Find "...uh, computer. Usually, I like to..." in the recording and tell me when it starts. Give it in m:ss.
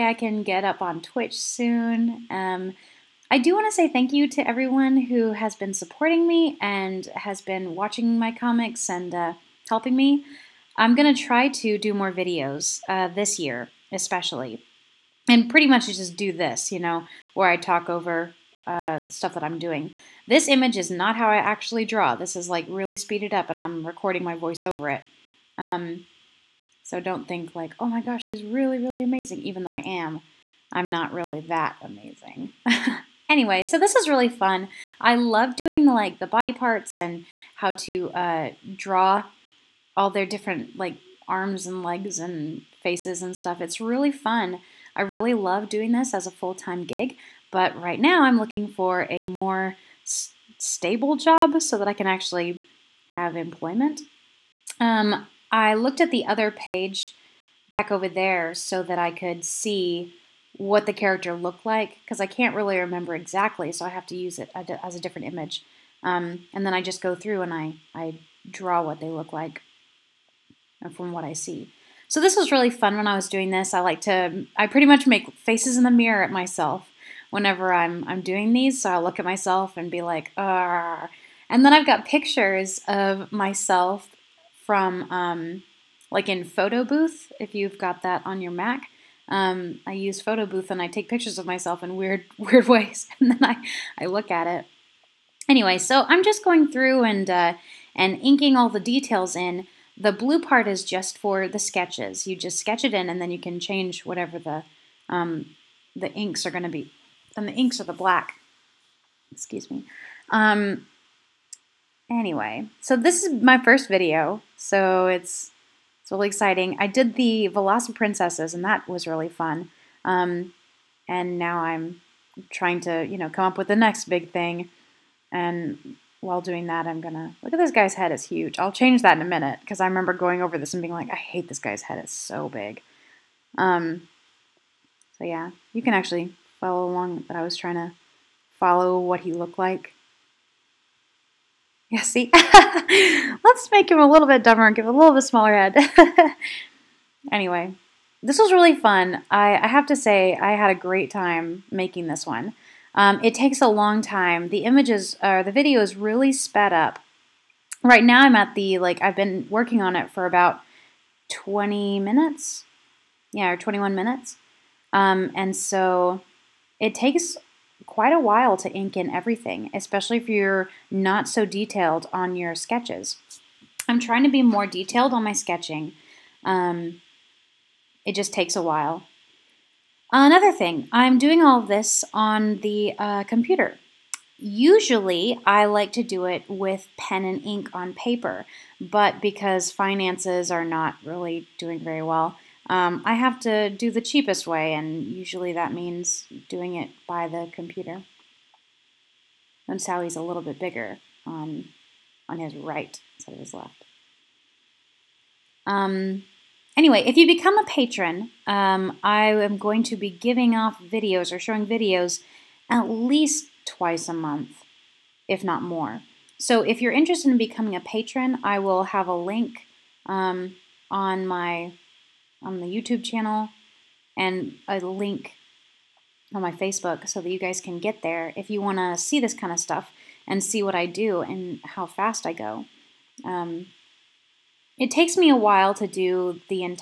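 3:02.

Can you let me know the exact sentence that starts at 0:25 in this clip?
Um, so don't think like, oh my gosh, she's really, really amazing, even though I am.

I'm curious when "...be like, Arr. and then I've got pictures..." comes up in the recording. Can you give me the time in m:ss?
1:19.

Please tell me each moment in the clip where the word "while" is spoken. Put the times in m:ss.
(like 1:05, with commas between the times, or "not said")
2:06, 2:48, 2:58, 3:55.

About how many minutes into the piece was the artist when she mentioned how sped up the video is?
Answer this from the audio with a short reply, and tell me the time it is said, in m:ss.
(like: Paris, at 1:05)
21, at 2:43.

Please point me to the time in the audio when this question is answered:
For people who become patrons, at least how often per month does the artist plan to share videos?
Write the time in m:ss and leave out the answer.
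3:33.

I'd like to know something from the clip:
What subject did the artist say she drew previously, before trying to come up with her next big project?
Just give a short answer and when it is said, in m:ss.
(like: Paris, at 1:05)
the princesses, at 1:57.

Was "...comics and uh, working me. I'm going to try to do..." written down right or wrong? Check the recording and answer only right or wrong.
wrong.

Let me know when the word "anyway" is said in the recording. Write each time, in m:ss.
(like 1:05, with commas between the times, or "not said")
0:33, 1:35, 1:52, 2:27, 3:26.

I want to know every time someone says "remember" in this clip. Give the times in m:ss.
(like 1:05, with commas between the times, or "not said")
1:02, 2:09.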